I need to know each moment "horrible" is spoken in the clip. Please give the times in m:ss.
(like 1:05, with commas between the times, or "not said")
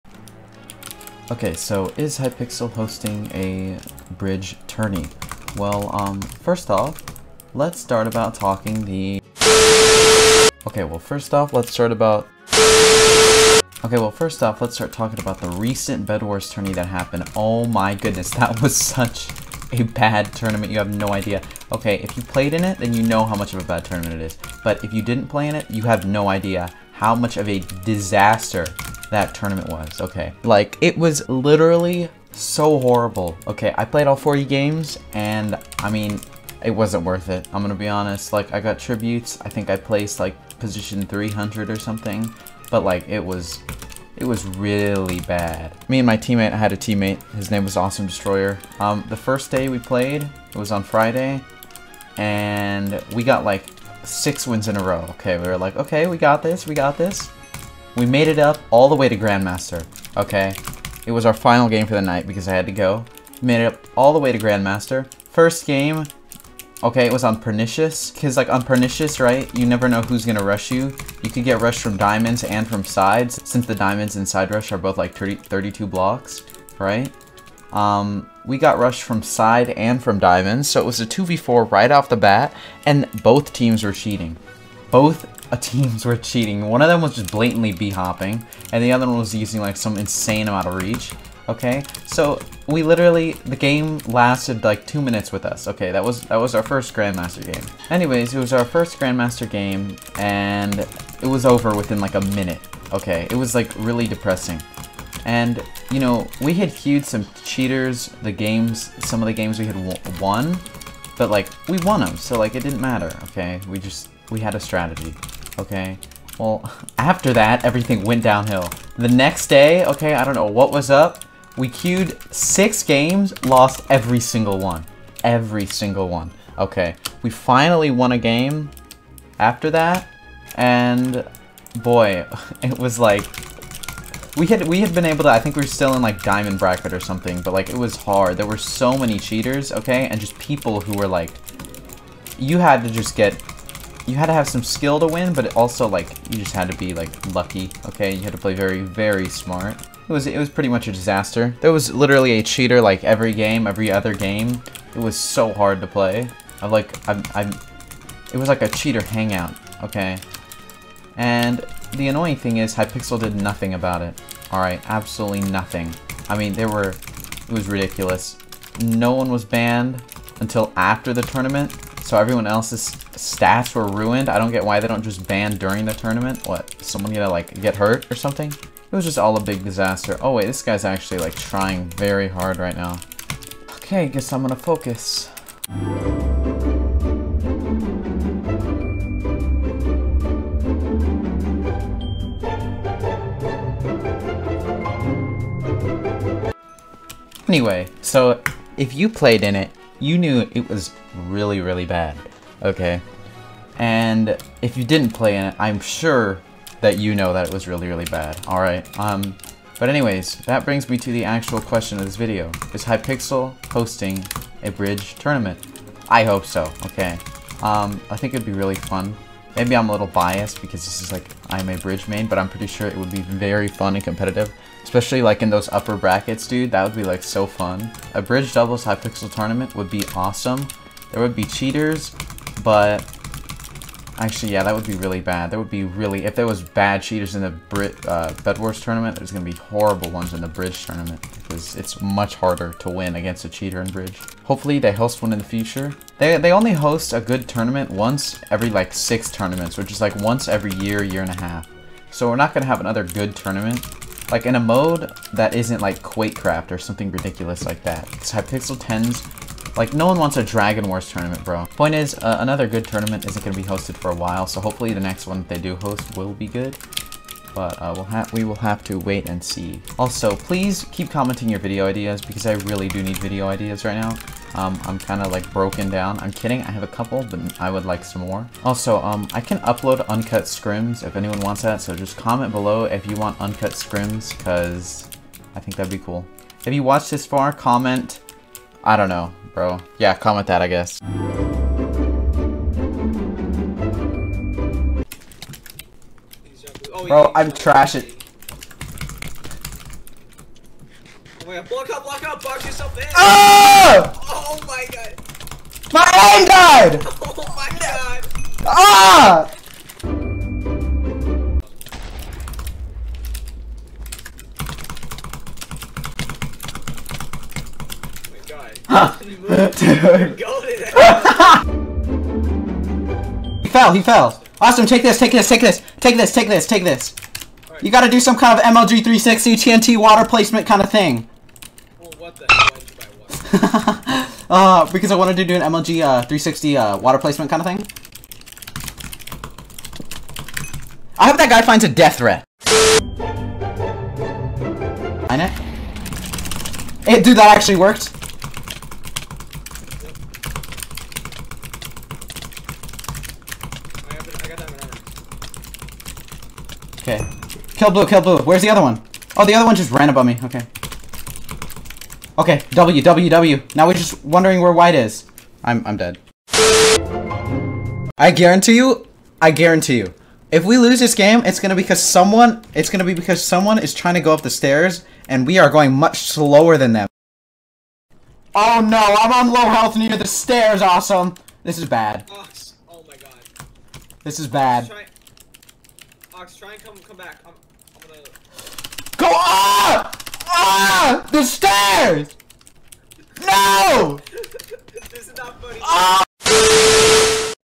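0:32, 3:59.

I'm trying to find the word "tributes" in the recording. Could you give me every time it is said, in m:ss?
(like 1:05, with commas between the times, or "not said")
0:38.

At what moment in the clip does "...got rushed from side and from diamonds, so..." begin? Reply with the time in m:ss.
1:18.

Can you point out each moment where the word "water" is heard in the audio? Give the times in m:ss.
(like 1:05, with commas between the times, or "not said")
5:29, 5:36.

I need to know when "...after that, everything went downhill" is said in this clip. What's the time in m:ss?
1:56.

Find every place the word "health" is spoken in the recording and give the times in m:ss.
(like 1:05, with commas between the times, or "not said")
6:19.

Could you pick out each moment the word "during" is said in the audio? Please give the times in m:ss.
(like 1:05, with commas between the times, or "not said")
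2:55.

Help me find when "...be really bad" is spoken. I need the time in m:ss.
3:54.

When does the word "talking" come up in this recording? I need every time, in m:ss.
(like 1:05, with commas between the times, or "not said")
0:08, 0:14.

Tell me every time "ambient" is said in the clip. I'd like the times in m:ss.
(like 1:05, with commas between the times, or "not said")
not said.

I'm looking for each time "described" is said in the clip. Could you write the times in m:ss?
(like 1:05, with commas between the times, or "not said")
not said.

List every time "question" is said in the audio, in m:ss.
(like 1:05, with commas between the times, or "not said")
3:31.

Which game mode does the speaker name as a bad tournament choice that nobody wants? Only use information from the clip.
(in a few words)
Dragon Wars.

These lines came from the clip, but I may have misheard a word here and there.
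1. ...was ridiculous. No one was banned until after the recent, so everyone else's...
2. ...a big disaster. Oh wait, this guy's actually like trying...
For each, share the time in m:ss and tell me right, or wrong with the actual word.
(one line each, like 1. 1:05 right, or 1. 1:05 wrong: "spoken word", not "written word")
1. 2:47 wrong: "tournament", not "recent"
2. 2:59 right.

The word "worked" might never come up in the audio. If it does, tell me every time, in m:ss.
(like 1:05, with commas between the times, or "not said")
5:47.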